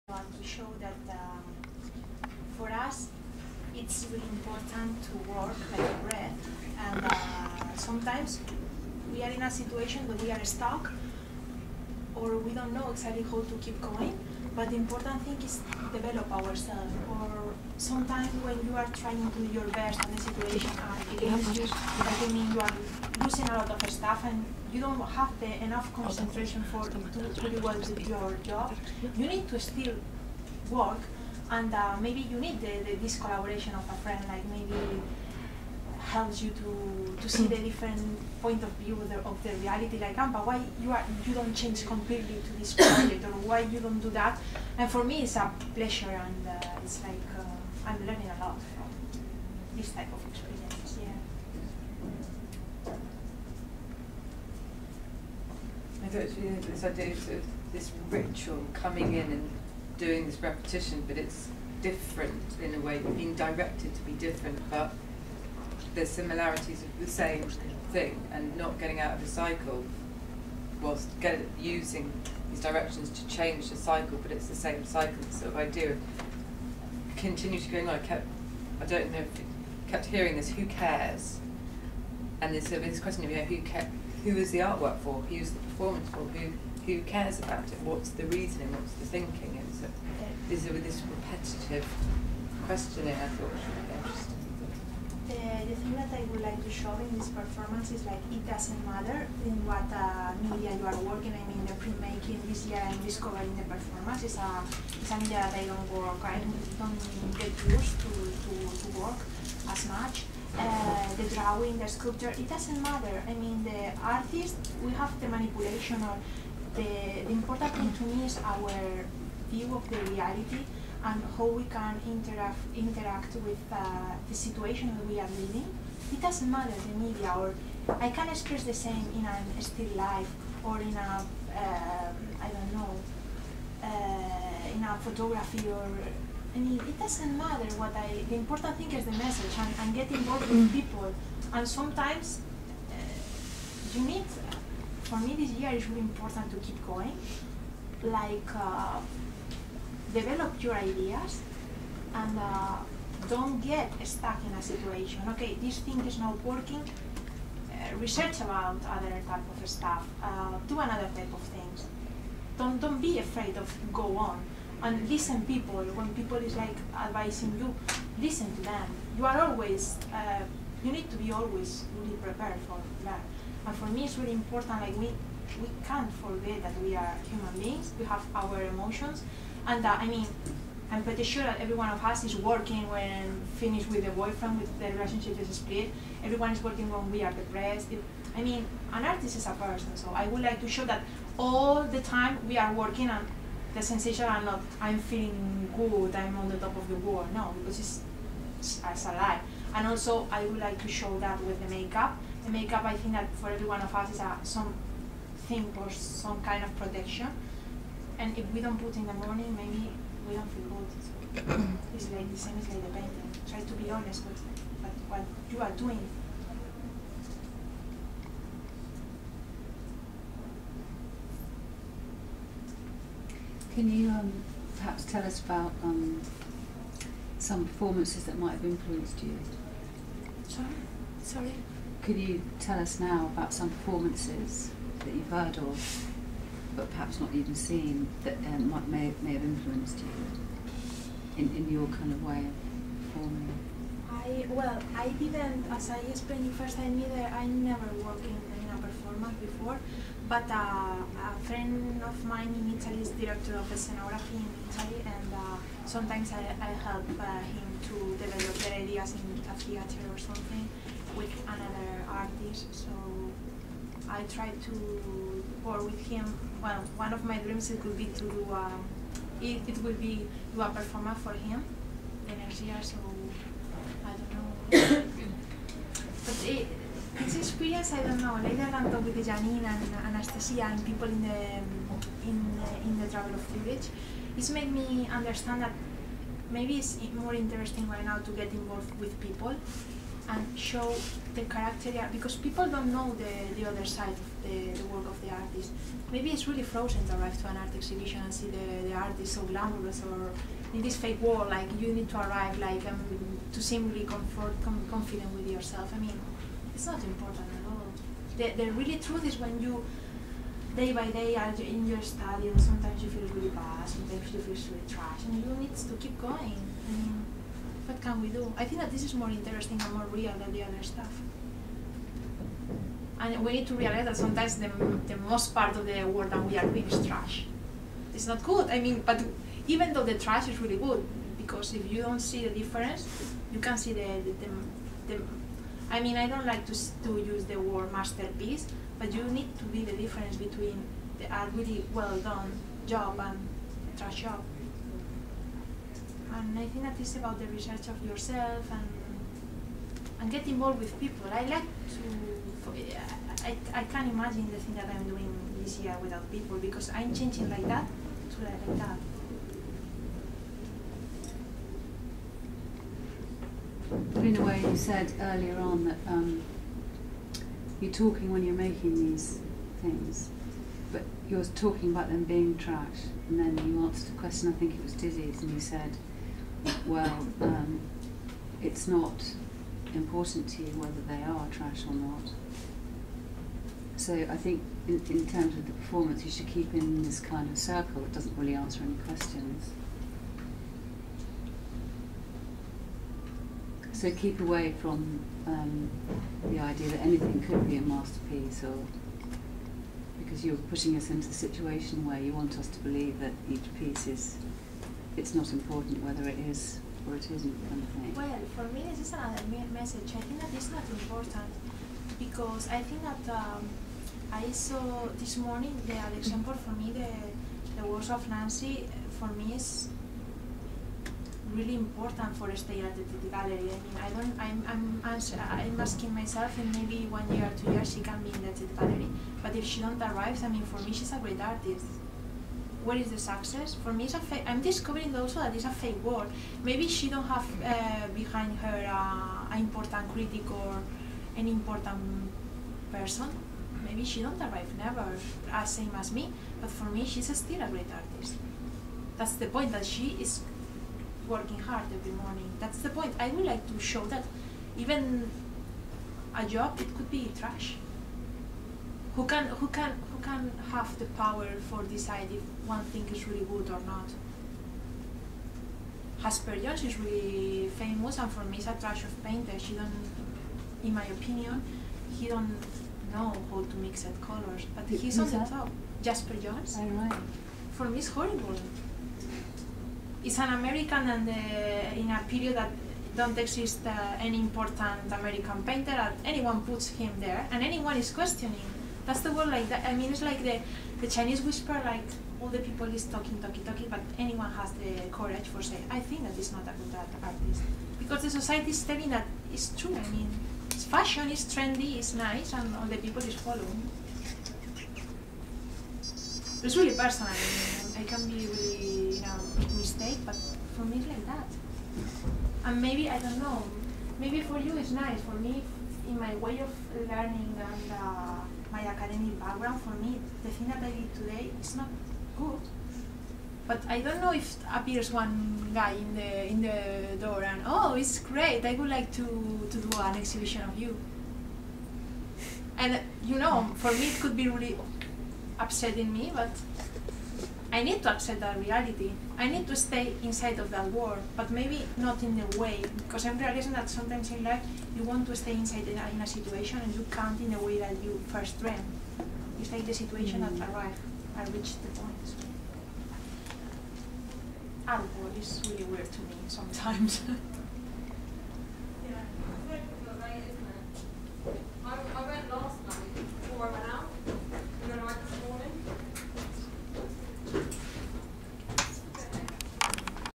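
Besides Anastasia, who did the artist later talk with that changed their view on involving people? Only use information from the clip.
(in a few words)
Janine.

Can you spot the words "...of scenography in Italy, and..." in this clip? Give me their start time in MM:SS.
04:13.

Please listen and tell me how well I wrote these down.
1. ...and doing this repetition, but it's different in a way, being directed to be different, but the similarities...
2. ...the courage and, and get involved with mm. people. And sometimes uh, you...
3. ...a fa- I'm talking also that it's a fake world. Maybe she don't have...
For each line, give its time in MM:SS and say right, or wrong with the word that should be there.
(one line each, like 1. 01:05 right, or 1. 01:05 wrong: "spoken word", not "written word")
1. 00:59 right
2. 02:19 wrong: "message", not "courage"
3. 07:14 wrong: "discovering", not "talking".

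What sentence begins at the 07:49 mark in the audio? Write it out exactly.
She don't, in my opinion, he don't know how to mix that colors, but he's Who's on the top.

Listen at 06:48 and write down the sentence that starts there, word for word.
Well, for me, this is another message.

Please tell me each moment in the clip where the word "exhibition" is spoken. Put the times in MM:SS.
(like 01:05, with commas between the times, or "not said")
04:57, 08:50.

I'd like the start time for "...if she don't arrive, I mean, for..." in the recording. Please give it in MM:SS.
07:09.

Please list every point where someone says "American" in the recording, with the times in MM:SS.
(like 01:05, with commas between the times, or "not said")
08:00, 08:05.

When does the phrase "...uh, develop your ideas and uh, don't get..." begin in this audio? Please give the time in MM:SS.
02:28.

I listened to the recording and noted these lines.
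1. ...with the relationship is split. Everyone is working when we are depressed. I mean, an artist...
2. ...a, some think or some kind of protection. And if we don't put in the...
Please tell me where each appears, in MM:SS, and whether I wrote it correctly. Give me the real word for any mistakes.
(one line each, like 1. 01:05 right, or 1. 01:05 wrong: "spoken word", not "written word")
1. 03:04 right
2. 03:24 right.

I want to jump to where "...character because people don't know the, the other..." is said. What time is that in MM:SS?
04:51.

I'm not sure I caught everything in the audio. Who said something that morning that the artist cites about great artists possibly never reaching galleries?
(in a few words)
Nancy.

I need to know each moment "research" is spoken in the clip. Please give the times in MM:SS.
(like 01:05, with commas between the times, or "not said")
02:37, 05:47.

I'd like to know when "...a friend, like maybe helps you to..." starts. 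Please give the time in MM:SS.
00:33.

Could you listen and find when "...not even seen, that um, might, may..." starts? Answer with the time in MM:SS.
03:57.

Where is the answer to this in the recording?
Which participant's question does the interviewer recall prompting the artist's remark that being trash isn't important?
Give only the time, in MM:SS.
06:14.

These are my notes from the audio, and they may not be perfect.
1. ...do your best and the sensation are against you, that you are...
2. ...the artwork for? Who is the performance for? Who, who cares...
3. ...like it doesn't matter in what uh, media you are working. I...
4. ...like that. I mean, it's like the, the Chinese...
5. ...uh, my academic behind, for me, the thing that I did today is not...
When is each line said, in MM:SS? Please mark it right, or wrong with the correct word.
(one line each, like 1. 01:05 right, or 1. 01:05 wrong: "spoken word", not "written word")
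1. 00:19 wrong: "situation", not "sensation"
2. 01:24 right
3. 01:38 right
4. 08:09 right
5. 08:37 wrong: "background", not "behind".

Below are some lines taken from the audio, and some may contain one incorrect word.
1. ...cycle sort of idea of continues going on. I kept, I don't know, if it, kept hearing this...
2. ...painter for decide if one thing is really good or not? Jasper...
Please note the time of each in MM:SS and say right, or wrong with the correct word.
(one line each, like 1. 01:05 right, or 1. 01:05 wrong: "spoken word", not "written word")
1. 01:14 right
2. 07:41 wrong: "power", not "painter".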